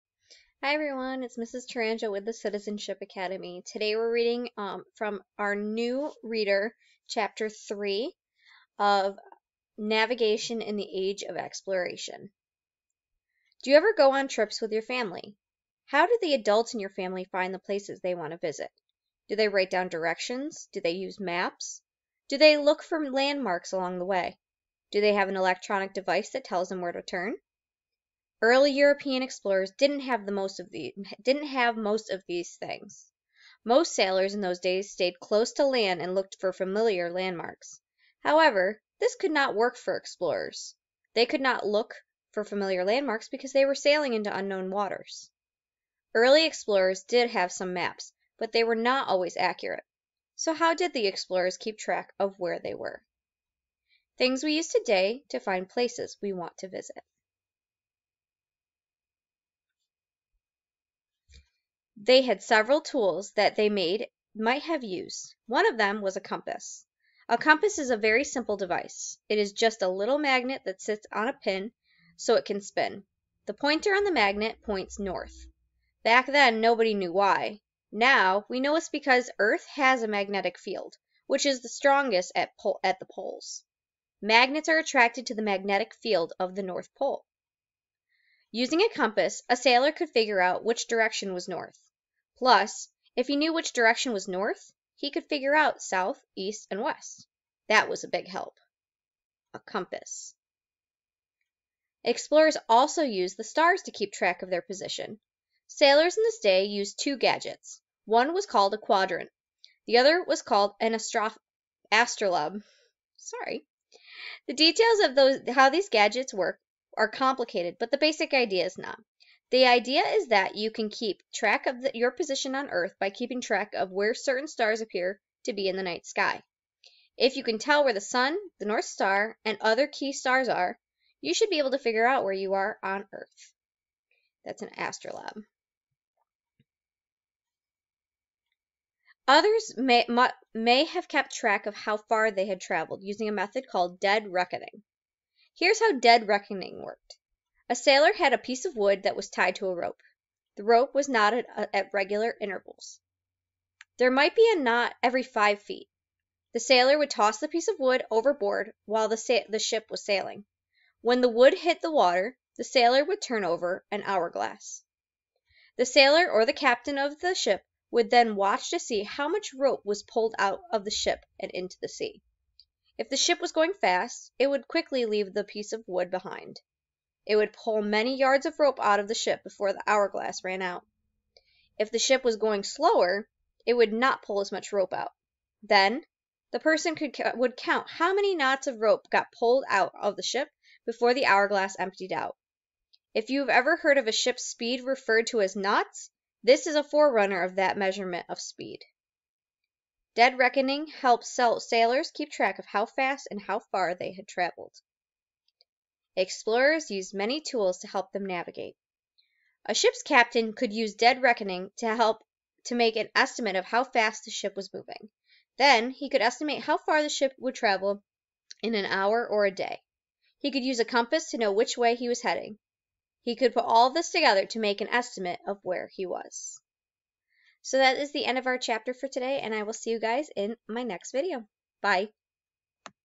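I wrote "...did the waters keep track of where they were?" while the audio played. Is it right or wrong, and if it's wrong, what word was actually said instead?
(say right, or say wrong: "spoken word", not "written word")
wrong: "explorers", not "waters".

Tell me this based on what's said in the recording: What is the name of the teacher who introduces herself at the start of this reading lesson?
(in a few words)
Mrs. Touranjoe.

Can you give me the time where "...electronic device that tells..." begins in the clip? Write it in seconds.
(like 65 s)
25 s.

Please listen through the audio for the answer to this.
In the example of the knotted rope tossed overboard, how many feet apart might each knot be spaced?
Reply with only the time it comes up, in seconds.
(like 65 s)
155 s.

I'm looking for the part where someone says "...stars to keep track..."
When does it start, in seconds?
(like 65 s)
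103 s.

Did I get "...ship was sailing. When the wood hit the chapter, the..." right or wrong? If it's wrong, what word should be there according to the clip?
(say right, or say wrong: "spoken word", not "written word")
wrong: "water", not "chapter".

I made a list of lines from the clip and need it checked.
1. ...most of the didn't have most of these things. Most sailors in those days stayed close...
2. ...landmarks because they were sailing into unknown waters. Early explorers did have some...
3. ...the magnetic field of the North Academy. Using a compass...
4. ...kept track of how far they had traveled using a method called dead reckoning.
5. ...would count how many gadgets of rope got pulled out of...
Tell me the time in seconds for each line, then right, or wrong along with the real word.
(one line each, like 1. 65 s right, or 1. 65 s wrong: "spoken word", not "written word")
1. 30 s right
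2. 42 s right
3. 85 s wrong: "Pole", not "Academy"
4. 141 s right
5. 187 s wrong: "knots", not "gadgets".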